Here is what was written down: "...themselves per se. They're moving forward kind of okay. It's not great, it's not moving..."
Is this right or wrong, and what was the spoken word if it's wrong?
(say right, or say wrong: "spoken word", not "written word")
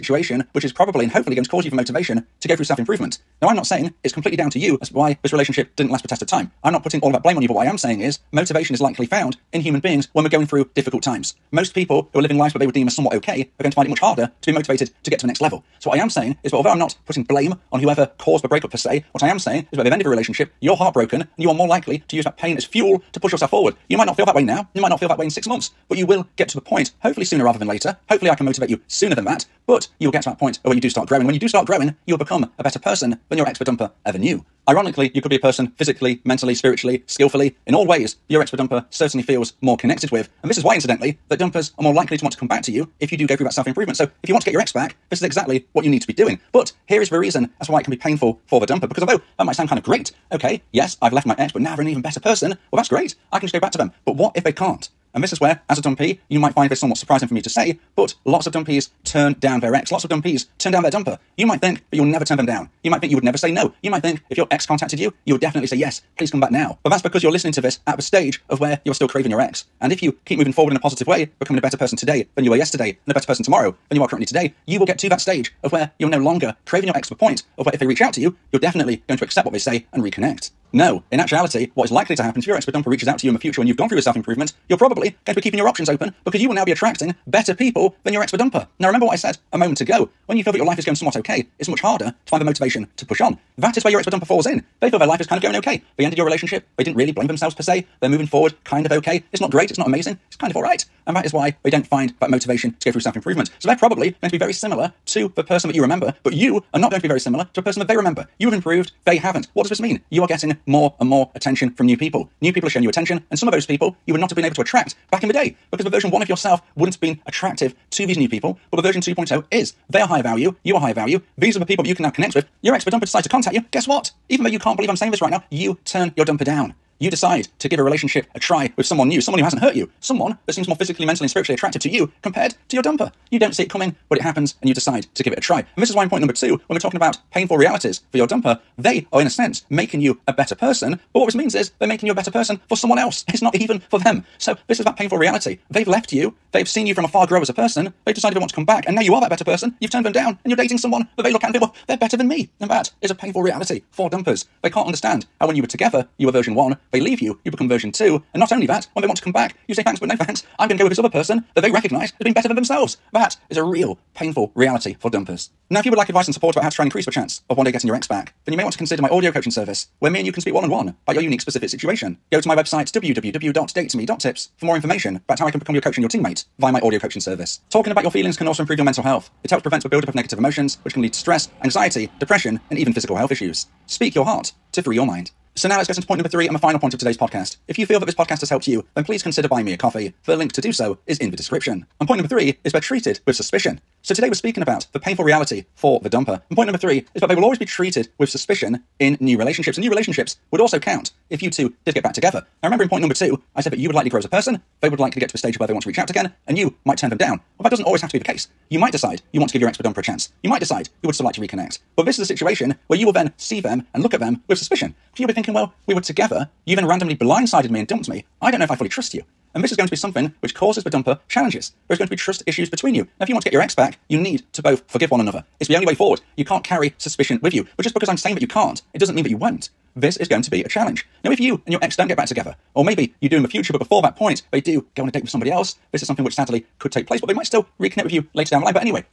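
wrong: "amazing", not "moving".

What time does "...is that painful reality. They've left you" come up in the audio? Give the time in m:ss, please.
2:24.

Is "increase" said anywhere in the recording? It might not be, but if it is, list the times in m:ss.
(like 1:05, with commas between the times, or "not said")
2:46.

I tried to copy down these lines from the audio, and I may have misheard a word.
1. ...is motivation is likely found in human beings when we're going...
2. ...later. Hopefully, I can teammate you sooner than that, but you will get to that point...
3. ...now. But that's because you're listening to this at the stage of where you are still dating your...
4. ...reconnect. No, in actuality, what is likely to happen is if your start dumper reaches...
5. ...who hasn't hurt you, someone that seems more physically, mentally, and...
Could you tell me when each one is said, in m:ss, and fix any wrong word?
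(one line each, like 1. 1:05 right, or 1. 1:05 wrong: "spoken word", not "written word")
1. 0:07 right
2. 0:27 wrong: "motivate", not "teammate"
3. 1:06 wrong: "craving", not "dating"
4. 1:20 wrong: "expert", not "start"
5. 2:09 right.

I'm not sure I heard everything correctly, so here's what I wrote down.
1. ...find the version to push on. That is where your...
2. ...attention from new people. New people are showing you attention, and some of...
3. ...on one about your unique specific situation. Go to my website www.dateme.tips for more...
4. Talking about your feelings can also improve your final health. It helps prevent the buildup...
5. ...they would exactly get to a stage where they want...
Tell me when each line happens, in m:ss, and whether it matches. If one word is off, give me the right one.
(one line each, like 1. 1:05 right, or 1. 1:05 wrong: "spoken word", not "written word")
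1. 1:32 wrong: "motivation", not "version"
2. 1:51 right
3. 2:50 right
4. 2:57 wrong: "mental", not "final"
5. 3:24 wrong: "likely", not "exactly".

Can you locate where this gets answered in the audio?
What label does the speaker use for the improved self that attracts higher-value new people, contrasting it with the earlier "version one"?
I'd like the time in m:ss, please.
1:58.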